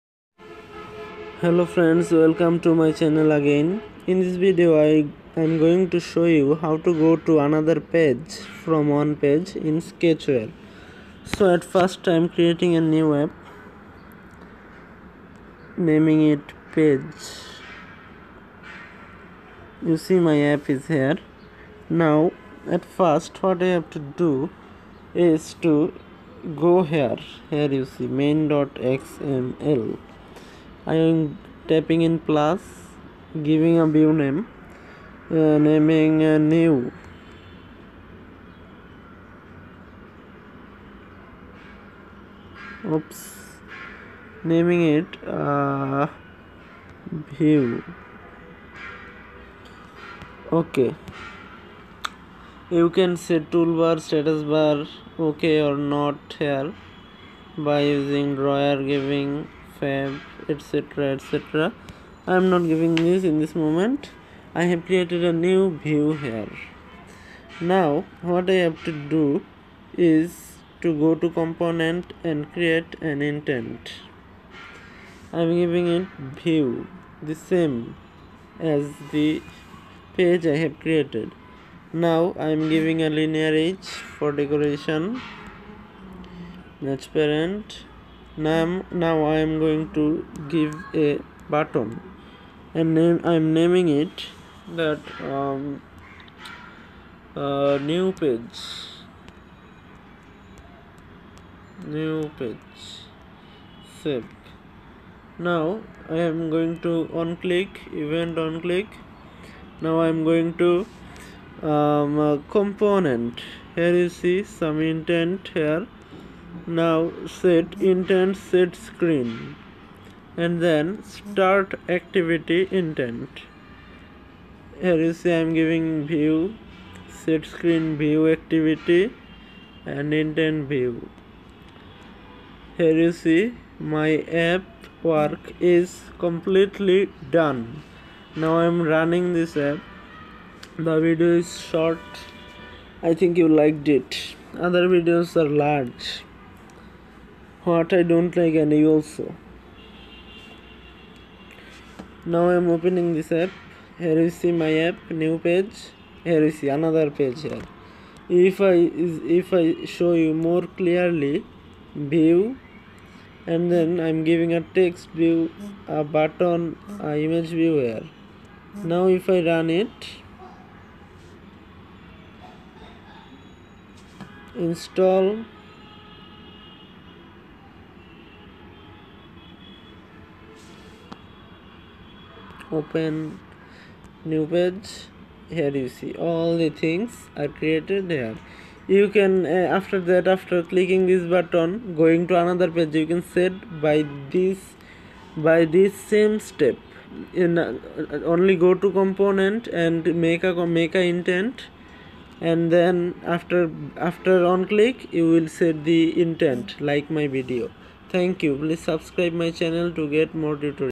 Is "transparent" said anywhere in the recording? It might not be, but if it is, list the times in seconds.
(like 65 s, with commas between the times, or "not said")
86 s.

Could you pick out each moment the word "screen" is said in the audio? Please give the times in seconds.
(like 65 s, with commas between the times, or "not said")
118 s, 127 s.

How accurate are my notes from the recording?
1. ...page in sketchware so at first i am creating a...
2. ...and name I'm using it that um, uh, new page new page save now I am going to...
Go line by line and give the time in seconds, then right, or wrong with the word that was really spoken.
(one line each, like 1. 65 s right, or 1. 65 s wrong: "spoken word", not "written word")
1. 9 s right
2. 92 s wrong: "naming", not "using".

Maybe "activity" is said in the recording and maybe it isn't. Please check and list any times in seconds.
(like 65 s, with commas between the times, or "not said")
121 s, 128 s.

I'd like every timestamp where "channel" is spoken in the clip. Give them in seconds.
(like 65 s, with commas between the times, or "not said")
2 s, 209 s.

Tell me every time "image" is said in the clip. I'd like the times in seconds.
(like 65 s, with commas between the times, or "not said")
167 s.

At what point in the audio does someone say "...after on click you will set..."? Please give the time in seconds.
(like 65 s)
204 s.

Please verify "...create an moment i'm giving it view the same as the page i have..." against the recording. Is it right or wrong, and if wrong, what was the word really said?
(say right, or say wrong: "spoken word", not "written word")
wrong: "intent", not "moment".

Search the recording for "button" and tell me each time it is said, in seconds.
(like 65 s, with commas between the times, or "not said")
91 s, 166 s, 191 s.